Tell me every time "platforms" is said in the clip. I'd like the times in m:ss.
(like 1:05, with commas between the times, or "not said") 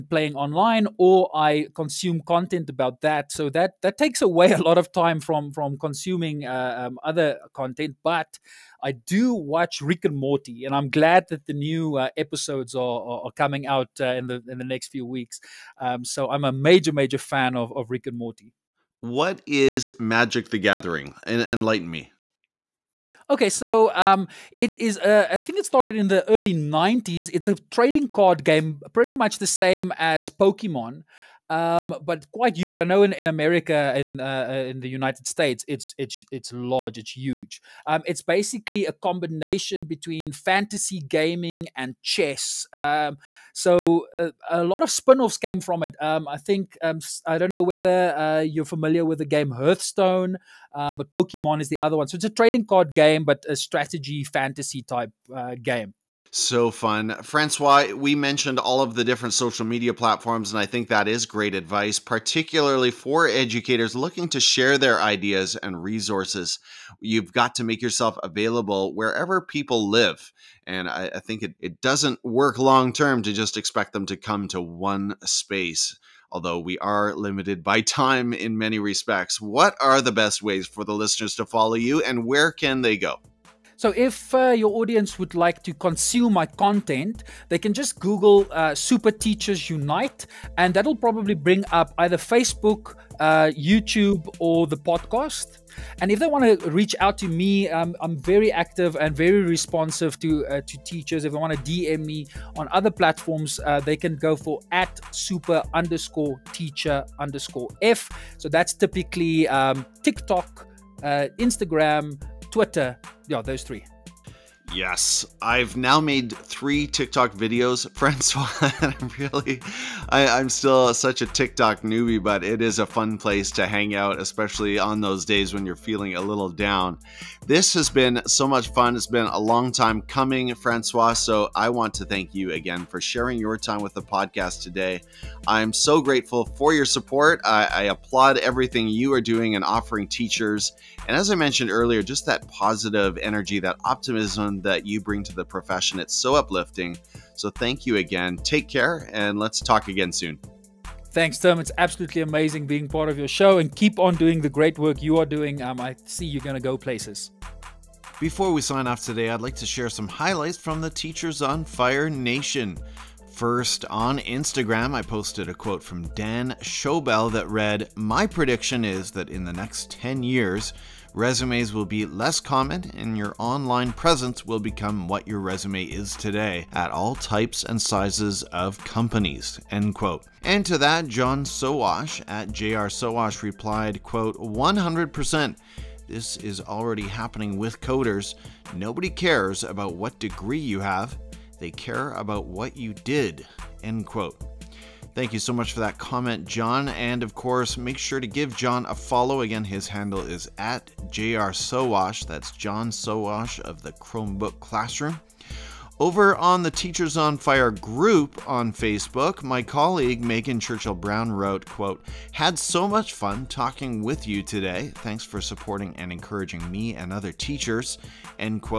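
0:59, 1:42.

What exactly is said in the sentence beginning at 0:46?
Um, I think um, I don't know whether uh, you're familiar with the game Hearthstone, uh, but Pokemon is the other one.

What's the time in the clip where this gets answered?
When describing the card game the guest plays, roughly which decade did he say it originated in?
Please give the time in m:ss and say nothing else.
0:26.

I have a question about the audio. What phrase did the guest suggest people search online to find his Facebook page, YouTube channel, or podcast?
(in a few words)
Super Teachers Unite.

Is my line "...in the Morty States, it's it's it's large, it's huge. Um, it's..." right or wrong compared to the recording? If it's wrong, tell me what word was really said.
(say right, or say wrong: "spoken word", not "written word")
wrong: "United", not "Morty".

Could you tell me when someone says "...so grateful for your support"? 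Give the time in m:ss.
2:15.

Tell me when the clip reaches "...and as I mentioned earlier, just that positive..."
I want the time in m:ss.
2:21.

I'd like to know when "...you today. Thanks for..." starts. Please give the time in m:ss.
3:34.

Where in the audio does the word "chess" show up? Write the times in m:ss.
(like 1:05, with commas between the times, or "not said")
0:42.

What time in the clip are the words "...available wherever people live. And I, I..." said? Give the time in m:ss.
1:08.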